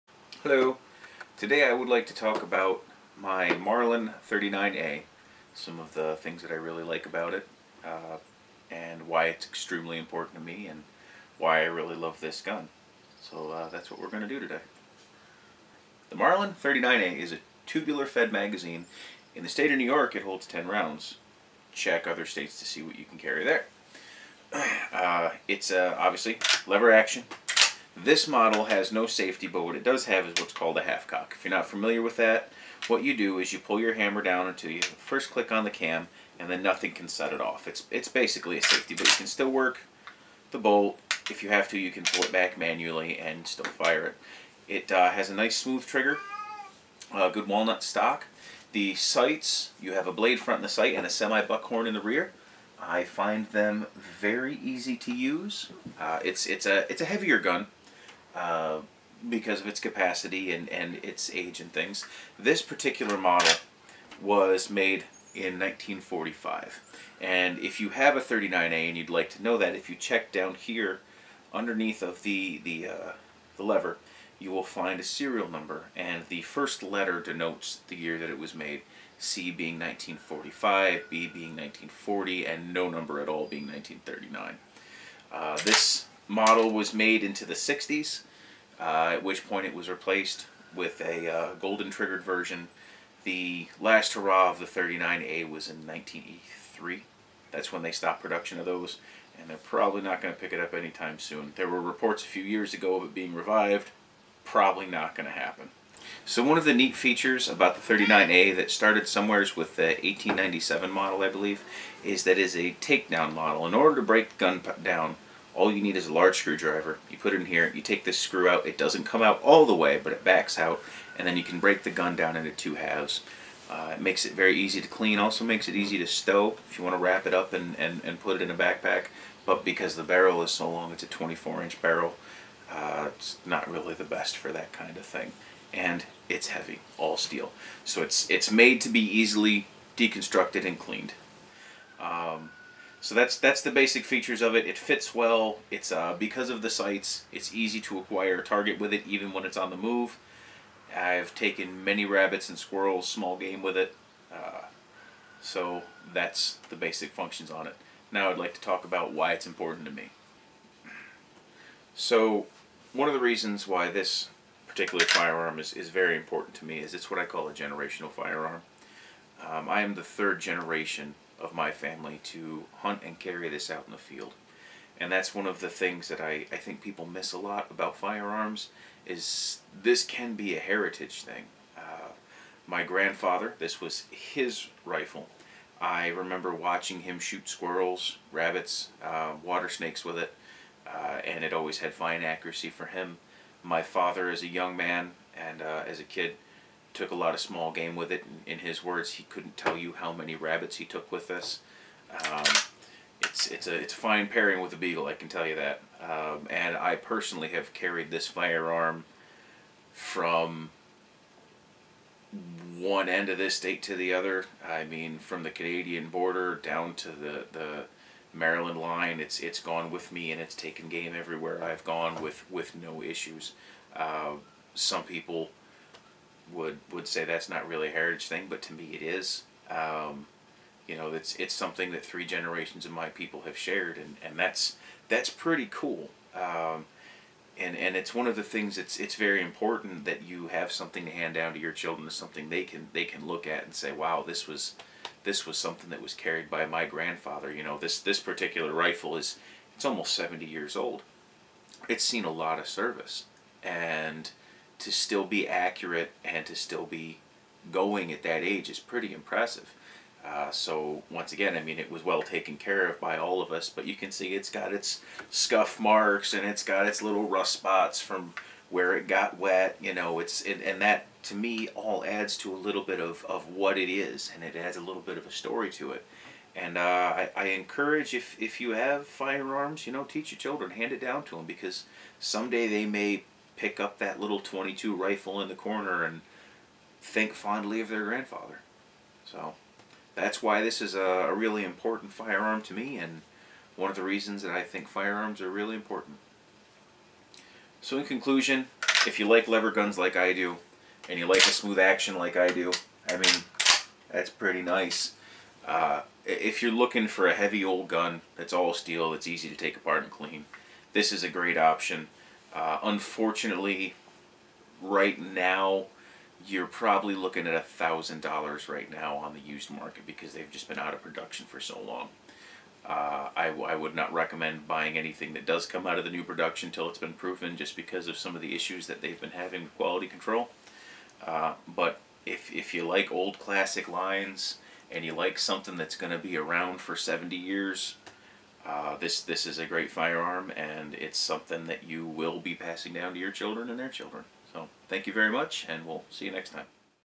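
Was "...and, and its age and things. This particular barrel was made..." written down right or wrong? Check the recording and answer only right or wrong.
wrong.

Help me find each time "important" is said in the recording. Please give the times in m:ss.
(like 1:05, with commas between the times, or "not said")
0:09, 2:39, 2:46, 3:59, 4:51, 4:55.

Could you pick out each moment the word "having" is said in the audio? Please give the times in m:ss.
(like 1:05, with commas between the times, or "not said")
5:29.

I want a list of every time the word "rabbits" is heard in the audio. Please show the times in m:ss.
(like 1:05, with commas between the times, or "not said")
2:32, 3:08, 3:20.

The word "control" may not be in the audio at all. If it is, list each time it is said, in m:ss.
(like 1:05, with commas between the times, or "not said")
5:30.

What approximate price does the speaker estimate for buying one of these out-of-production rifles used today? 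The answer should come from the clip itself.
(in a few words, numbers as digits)
$1,000.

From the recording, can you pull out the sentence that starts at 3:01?
Uh, my grandfather, this was his rifle.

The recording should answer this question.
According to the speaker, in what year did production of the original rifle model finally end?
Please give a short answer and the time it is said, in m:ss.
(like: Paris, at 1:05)
1983, at 1:35.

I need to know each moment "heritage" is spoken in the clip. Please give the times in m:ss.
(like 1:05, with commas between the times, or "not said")
3:00, 3:47.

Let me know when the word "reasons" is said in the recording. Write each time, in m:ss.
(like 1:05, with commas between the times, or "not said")
2:43, 4:54.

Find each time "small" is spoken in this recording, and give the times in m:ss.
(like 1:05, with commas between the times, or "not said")
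2:33, 3:17.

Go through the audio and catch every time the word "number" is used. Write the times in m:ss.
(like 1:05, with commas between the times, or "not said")
1:15, 1:22.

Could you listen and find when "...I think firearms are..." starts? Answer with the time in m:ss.
4:54.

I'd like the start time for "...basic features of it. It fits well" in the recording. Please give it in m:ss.
2:23.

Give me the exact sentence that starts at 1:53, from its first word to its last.
In order to break the gun down, all you need is a large screwdriver.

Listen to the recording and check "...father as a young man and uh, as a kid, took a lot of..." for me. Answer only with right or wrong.
right.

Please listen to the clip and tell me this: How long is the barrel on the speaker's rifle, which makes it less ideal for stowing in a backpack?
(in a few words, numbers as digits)
24-inch.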